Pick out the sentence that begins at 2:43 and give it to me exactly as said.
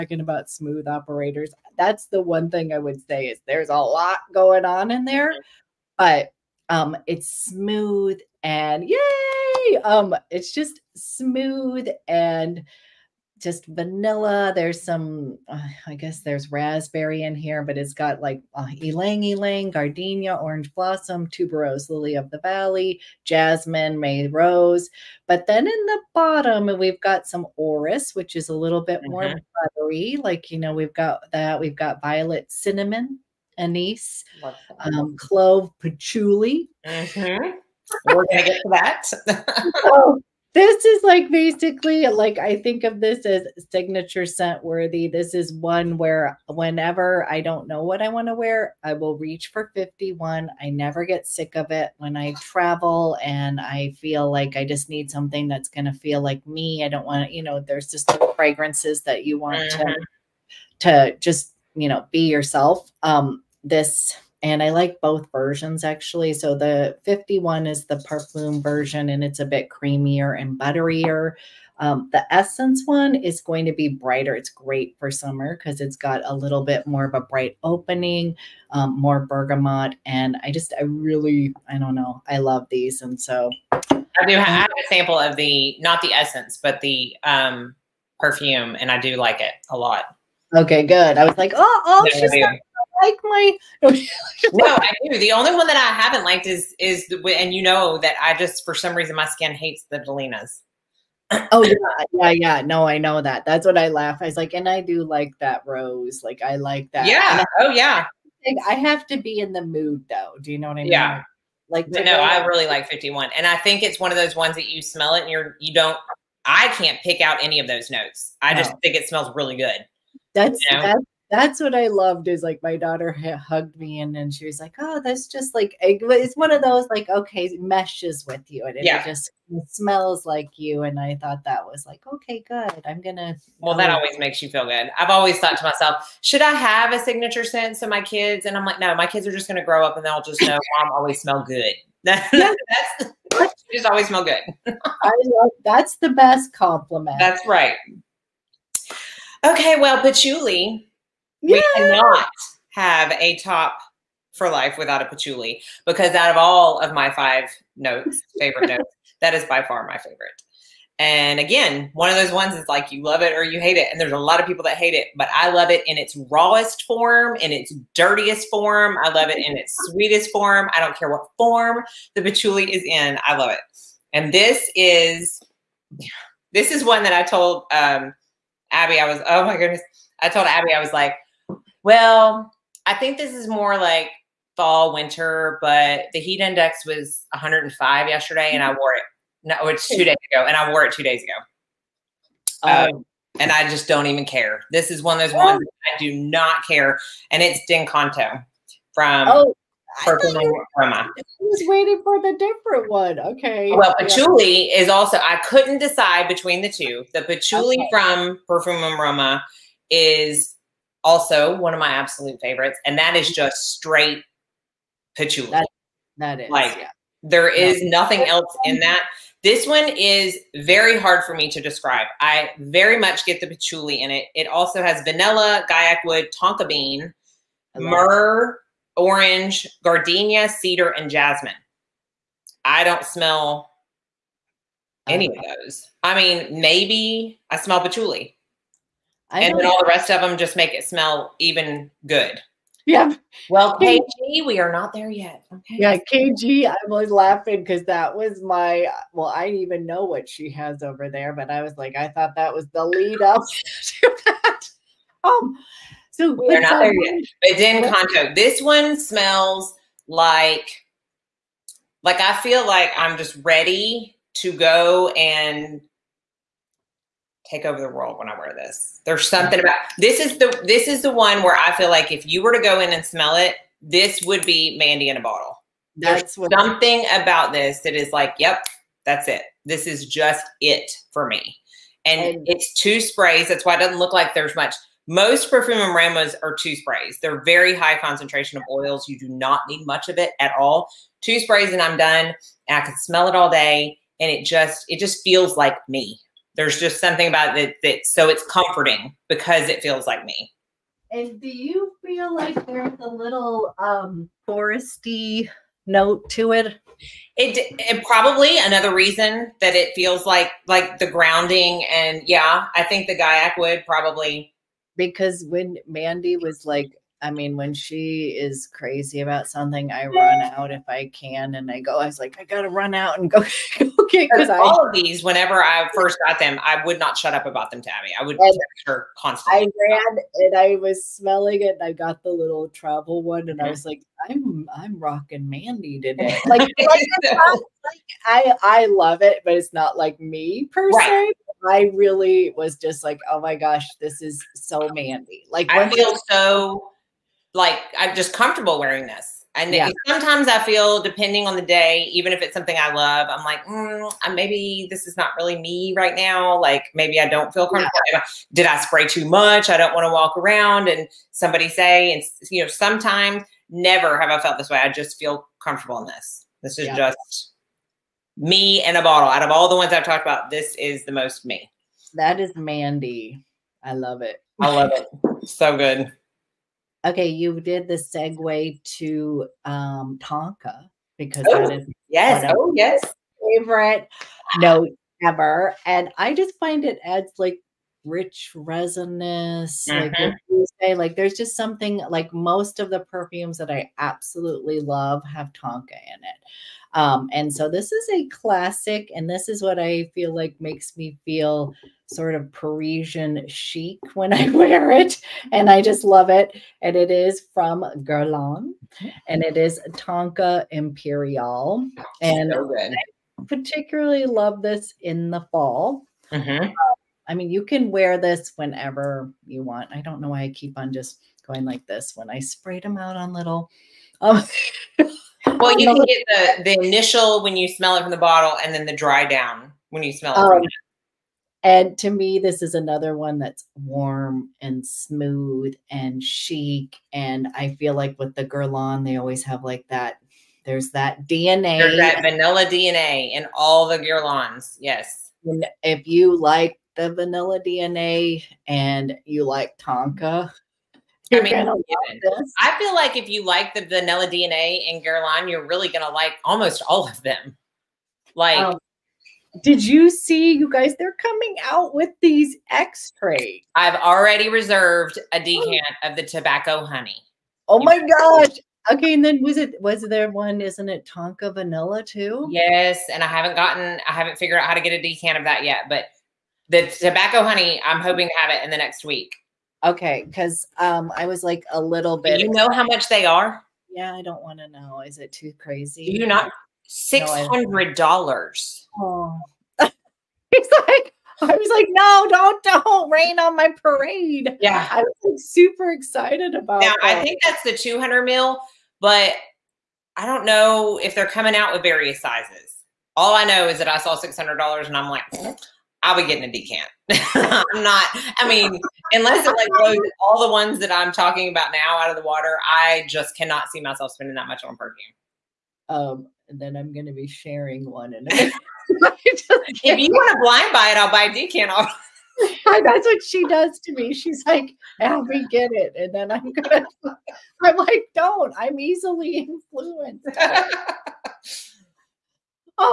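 And there's a lot of people that hate it, but I love it in its rawest form, in its dirtiest form.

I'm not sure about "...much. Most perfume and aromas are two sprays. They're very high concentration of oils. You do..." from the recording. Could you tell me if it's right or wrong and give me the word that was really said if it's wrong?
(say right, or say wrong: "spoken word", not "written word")
right.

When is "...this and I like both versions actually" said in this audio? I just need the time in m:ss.
1:03.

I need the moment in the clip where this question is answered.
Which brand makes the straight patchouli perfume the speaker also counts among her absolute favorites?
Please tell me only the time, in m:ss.
3:28.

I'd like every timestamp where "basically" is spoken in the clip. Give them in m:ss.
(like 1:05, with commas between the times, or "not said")
0:41.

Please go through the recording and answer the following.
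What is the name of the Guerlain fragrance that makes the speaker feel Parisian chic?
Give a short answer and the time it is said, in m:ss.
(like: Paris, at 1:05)
Tonka Imperiale, at 6:49.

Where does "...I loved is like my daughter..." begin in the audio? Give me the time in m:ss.
2:01.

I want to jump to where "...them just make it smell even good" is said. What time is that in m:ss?
4:00.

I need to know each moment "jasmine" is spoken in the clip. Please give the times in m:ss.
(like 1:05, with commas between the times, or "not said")
0:23, 3:51.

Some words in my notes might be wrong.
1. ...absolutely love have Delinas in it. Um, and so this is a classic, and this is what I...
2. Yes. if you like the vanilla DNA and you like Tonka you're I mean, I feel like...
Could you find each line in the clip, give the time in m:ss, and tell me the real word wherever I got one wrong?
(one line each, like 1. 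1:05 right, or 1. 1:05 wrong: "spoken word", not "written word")
1. 6:33 wrong: "Tonka", not "Delinas"
2. 7:24 right.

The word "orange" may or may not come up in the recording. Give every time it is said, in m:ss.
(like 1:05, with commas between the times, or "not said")
0:20, 3:48.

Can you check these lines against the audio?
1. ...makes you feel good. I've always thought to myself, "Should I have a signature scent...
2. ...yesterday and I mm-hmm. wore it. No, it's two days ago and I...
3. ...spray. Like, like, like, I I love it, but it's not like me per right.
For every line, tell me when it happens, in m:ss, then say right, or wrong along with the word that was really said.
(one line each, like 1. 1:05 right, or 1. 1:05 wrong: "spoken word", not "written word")
1. 2:14 right
2. 3:08 right
3. 5:35 wrong: "today", not "spray".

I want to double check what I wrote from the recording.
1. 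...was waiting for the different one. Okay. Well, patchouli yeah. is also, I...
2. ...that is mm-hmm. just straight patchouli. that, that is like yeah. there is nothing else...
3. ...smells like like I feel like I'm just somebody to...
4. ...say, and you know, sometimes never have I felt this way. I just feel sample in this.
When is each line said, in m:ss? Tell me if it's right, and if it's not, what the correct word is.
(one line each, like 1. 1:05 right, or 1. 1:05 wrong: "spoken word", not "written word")
1. 3:20 right
2. 3:32 right
3. 4:18 wrong: "ready", not "somebody"
4. 6:01 wrong: "comfortable", not "sample".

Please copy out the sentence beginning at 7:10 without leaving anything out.
Um, and to me, this is another one that's warm and smooth and chic.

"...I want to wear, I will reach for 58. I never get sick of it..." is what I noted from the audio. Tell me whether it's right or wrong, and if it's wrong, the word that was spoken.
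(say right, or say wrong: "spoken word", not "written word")
wrong: "51", not "58".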